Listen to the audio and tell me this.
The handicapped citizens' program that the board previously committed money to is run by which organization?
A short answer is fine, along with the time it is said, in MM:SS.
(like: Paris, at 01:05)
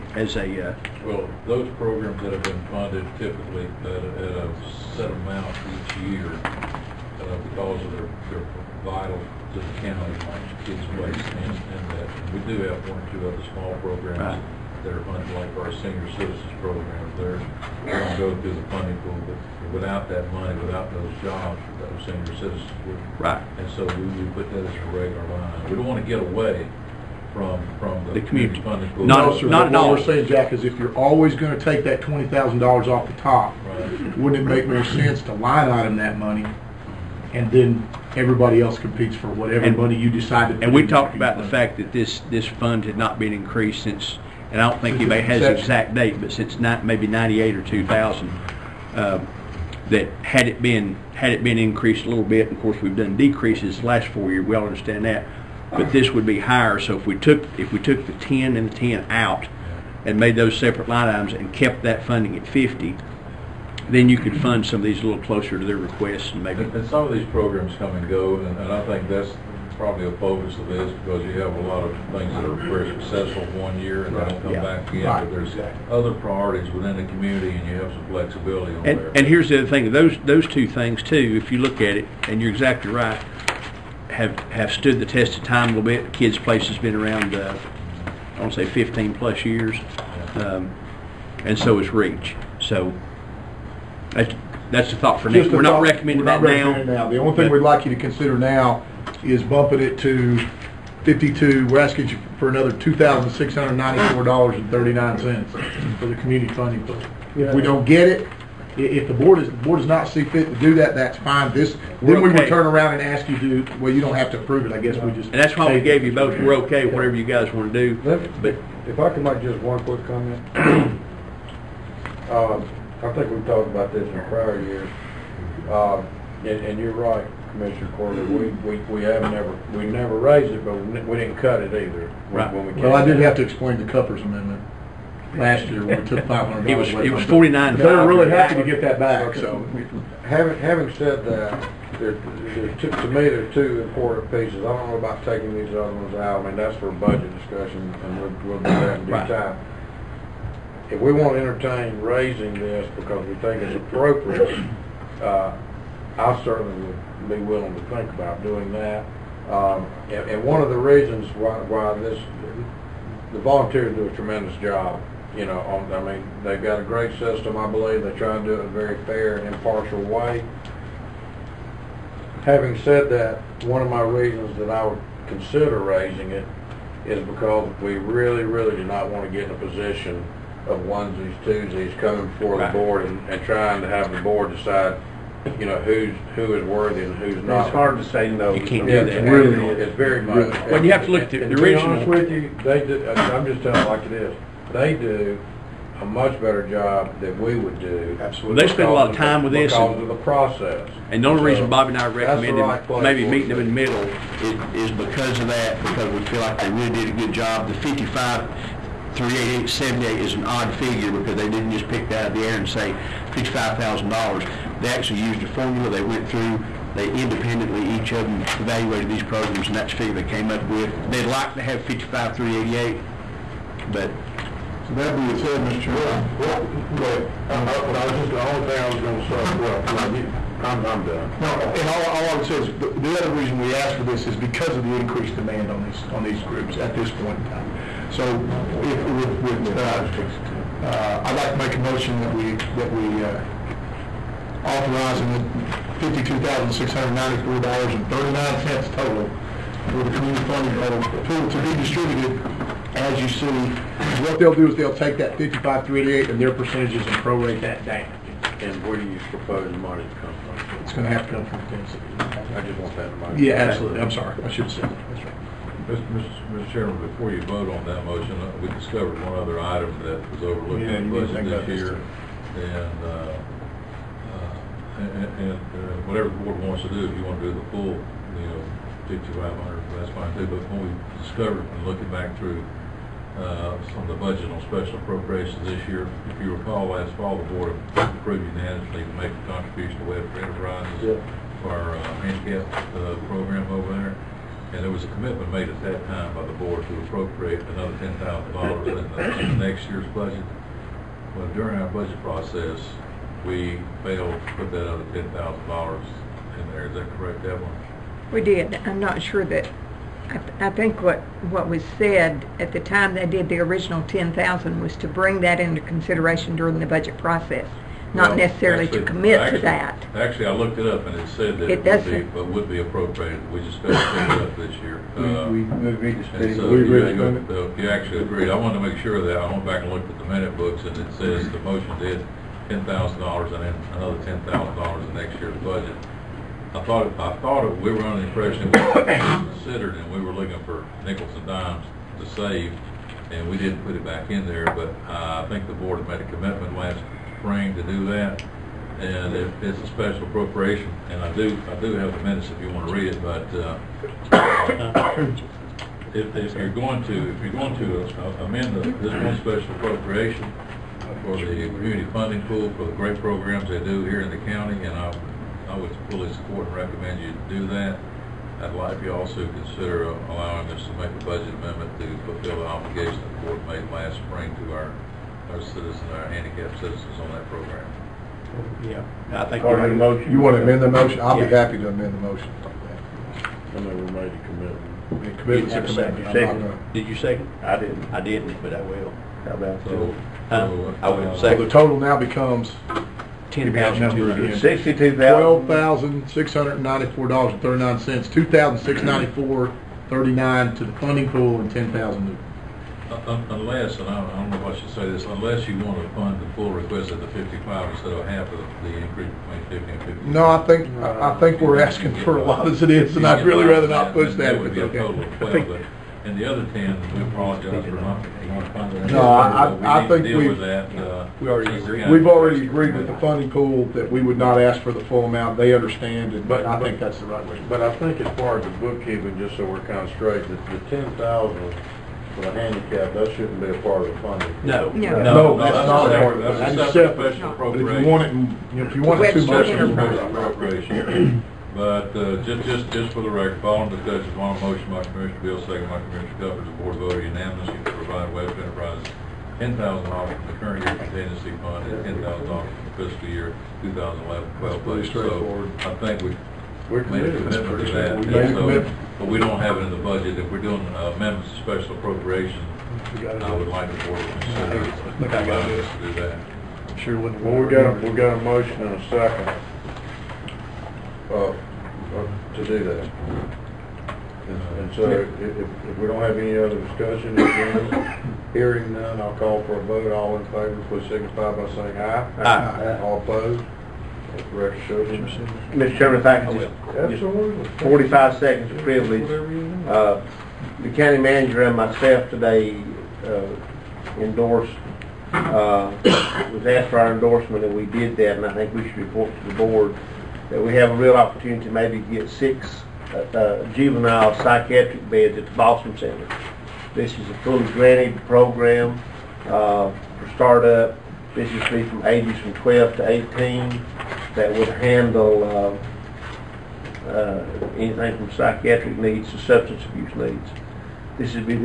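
Webster Enterprises, at 07:28.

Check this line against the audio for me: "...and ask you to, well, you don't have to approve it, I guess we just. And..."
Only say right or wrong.
right.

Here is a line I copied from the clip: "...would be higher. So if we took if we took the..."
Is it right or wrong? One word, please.
right.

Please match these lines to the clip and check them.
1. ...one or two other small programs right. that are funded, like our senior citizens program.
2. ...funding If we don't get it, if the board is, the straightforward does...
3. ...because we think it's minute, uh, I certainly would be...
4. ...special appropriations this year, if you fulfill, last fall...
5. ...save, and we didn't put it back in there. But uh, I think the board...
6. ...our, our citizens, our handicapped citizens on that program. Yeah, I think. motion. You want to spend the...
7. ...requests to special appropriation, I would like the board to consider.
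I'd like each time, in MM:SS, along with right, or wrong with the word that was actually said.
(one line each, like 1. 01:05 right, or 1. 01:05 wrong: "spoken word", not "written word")
1. 00:12 right
2. 01:46 wrong: "board", not "straightforward"
3. 02:32 wrong: "appropriate", not "minute"
4. 04:44 wrong: "recall", not "fulfill"
5. 05:42 right
6. 06:14 wrong: "amend", not "spend"
7. 07:41 wrong: "amendments", not "requests".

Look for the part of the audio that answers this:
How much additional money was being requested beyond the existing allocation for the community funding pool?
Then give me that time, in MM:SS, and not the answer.
01:42.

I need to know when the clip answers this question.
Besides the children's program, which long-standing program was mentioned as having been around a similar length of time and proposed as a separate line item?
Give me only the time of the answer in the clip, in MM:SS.
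01:31.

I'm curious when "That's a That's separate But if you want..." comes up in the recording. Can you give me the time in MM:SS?
07:16.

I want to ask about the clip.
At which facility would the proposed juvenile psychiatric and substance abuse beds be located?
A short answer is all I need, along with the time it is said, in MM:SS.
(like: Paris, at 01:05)
Balsam Center, at 08:25.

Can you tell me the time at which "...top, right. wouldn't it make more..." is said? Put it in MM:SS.
00:33.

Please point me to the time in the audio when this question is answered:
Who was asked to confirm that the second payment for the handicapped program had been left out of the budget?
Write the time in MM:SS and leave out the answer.
05:07.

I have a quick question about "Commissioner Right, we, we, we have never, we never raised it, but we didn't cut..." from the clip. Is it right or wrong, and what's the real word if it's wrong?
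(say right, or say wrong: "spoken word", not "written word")
wrong: "Corbin", not "Right".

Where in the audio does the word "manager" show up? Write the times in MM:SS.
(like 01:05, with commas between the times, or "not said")
08:11.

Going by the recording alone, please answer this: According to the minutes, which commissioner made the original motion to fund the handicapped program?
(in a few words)
Commissioner Beale.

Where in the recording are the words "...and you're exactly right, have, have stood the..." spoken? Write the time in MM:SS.
01:22.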